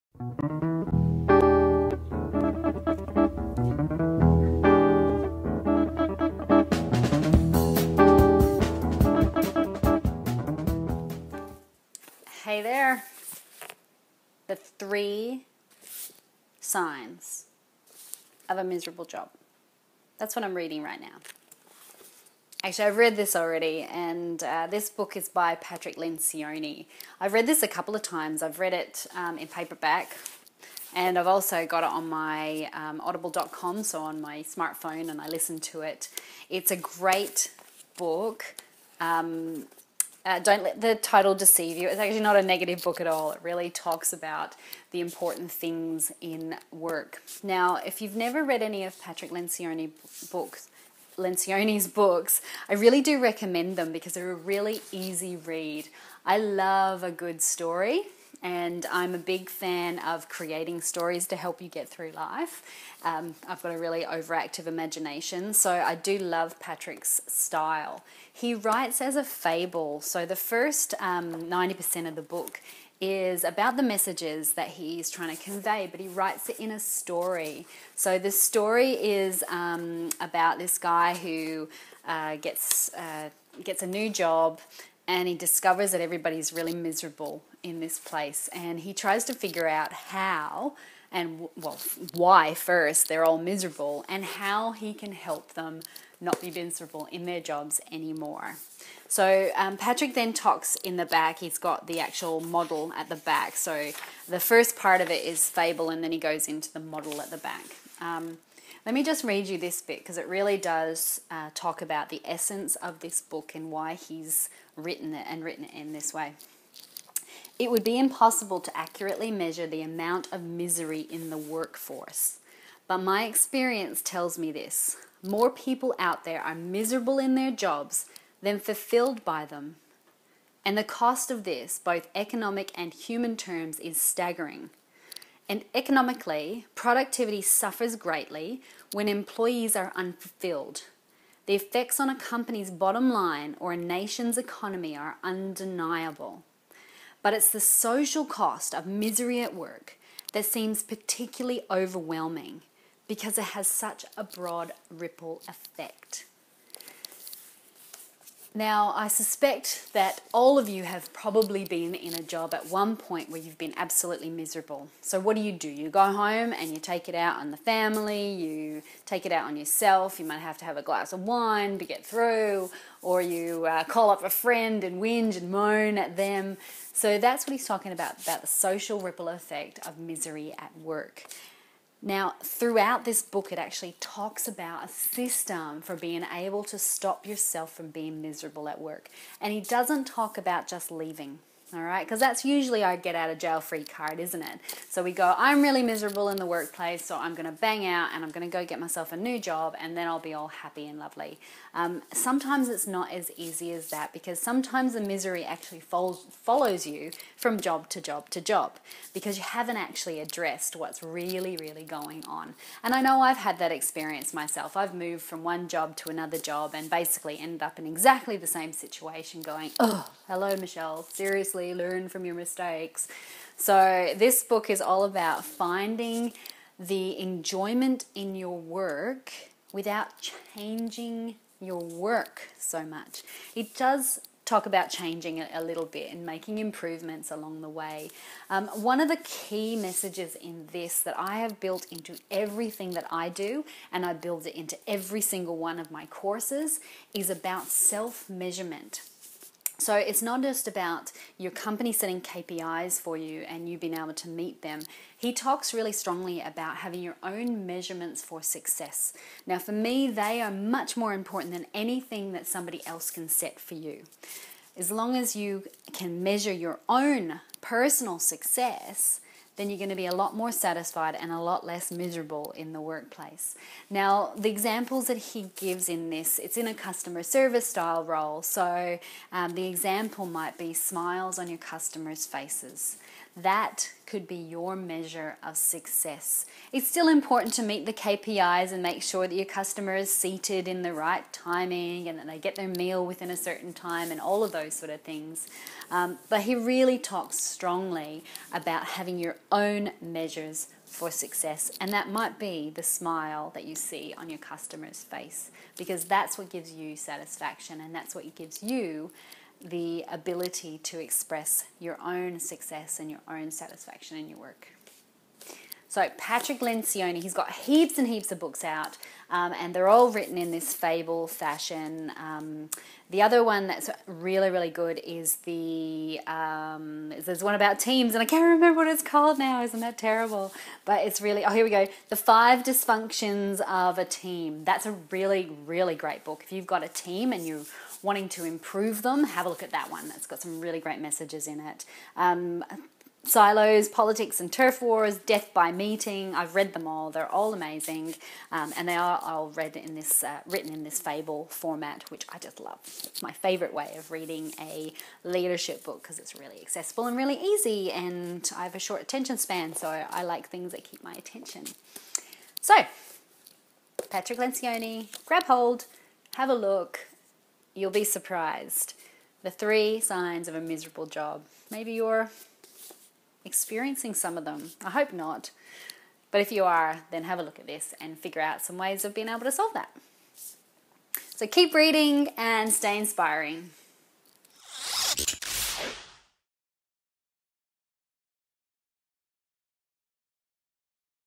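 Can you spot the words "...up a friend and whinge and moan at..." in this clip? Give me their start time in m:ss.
2:54.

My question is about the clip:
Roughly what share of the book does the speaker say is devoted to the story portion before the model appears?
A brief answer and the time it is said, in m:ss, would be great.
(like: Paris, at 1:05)
90%, at 1:11.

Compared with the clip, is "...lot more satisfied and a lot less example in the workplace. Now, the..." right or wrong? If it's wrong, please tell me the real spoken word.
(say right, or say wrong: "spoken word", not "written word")
wrong: "miserable", not "example".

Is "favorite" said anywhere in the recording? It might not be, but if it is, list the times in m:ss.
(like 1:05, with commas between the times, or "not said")
5:53.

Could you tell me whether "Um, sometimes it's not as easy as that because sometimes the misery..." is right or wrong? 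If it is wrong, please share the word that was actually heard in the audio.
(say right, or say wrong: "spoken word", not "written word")
right.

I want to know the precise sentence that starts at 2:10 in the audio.
And the cost of this, both economic and human terms, is staggering.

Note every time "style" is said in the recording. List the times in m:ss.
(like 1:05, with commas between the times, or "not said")
1:07, 4:37.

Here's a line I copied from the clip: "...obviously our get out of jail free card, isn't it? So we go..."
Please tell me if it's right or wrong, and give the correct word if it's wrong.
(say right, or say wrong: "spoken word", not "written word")
wrong: "usually", not "obviously".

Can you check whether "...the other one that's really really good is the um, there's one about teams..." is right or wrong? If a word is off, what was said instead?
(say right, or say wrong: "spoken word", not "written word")
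right.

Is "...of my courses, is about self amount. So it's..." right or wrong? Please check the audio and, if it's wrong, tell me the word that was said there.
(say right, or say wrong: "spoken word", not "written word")
wrong: "measurement", not "amount".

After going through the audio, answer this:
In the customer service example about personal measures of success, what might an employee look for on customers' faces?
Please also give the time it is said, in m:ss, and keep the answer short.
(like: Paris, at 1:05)
Smiles, at 4:40.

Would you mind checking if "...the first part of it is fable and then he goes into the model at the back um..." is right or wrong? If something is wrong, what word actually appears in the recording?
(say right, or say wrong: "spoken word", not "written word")
right.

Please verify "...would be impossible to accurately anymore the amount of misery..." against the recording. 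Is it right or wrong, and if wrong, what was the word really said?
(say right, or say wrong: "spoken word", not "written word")
wrong: "measure", not "anymore".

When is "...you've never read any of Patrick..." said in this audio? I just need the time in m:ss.
0:48.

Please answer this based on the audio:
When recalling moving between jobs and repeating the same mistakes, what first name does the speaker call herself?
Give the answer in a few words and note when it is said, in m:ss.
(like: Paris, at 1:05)
Michelle, at 3:40.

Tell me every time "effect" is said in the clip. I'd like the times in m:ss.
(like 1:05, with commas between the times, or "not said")
2:21, 2:35, 2:59.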